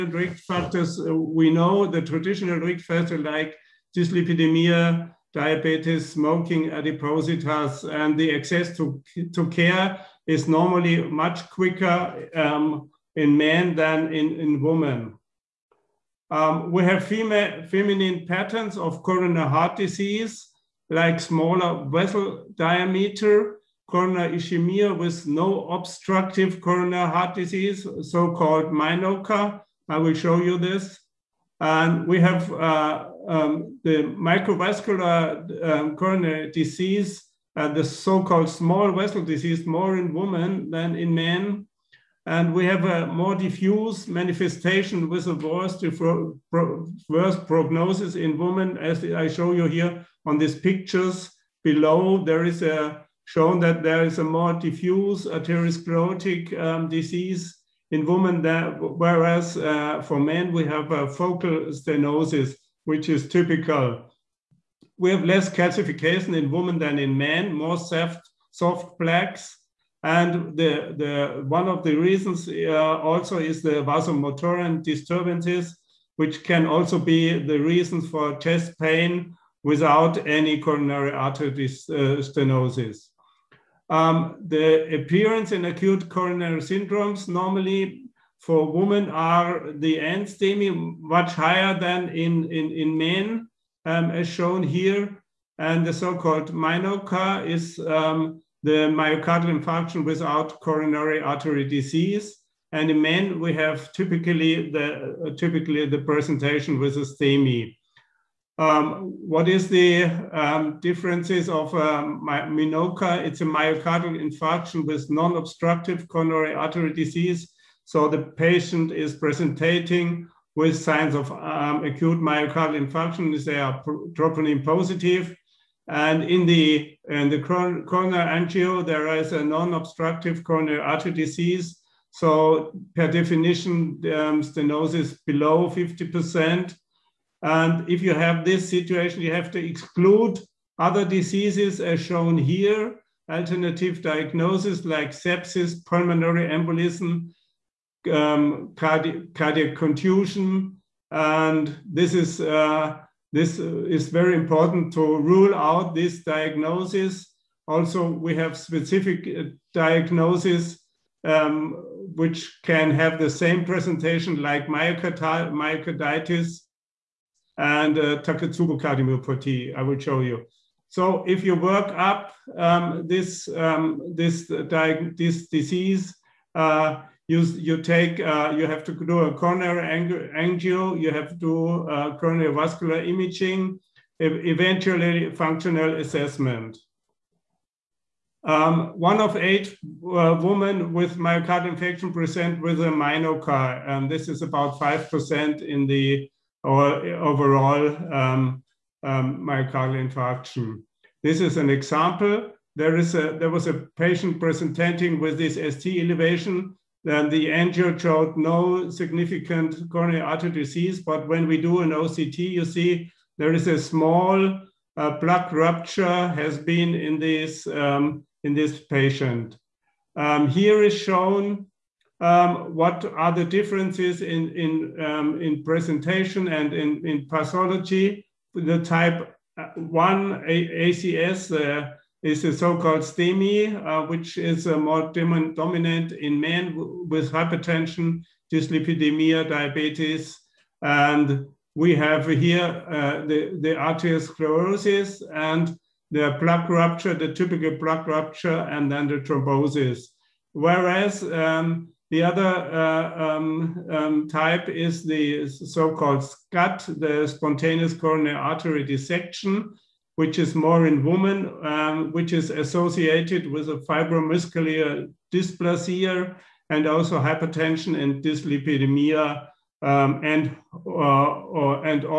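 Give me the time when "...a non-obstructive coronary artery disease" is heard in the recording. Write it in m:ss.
2:09.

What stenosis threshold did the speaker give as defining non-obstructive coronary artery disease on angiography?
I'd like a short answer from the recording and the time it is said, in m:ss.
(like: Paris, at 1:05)
below 50%, at 2:15.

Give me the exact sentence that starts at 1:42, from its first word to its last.
And in men, we have typically the, uh, typically the presentation with a STEMI.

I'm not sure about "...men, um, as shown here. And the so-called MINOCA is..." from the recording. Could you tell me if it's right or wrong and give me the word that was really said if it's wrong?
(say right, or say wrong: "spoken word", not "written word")
right.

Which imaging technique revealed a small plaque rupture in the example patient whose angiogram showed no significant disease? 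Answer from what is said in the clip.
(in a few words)
OCT.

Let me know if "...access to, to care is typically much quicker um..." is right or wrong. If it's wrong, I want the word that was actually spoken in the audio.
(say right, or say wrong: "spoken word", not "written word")
wrong: "normally", not "typically".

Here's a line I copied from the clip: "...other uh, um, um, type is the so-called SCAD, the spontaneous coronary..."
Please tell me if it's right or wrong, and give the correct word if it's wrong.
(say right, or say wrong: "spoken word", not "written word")
right.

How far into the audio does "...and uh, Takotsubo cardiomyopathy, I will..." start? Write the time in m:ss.
2:47.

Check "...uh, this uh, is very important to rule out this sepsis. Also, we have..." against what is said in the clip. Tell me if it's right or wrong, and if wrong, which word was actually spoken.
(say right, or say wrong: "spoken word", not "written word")
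wrong: "diagnosis", not "sepsis".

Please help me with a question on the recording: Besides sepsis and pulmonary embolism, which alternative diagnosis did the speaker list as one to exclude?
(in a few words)
cardiac contusion.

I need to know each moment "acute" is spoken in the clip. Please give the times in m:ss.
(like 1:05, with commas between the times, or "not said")
1:25, 2:01.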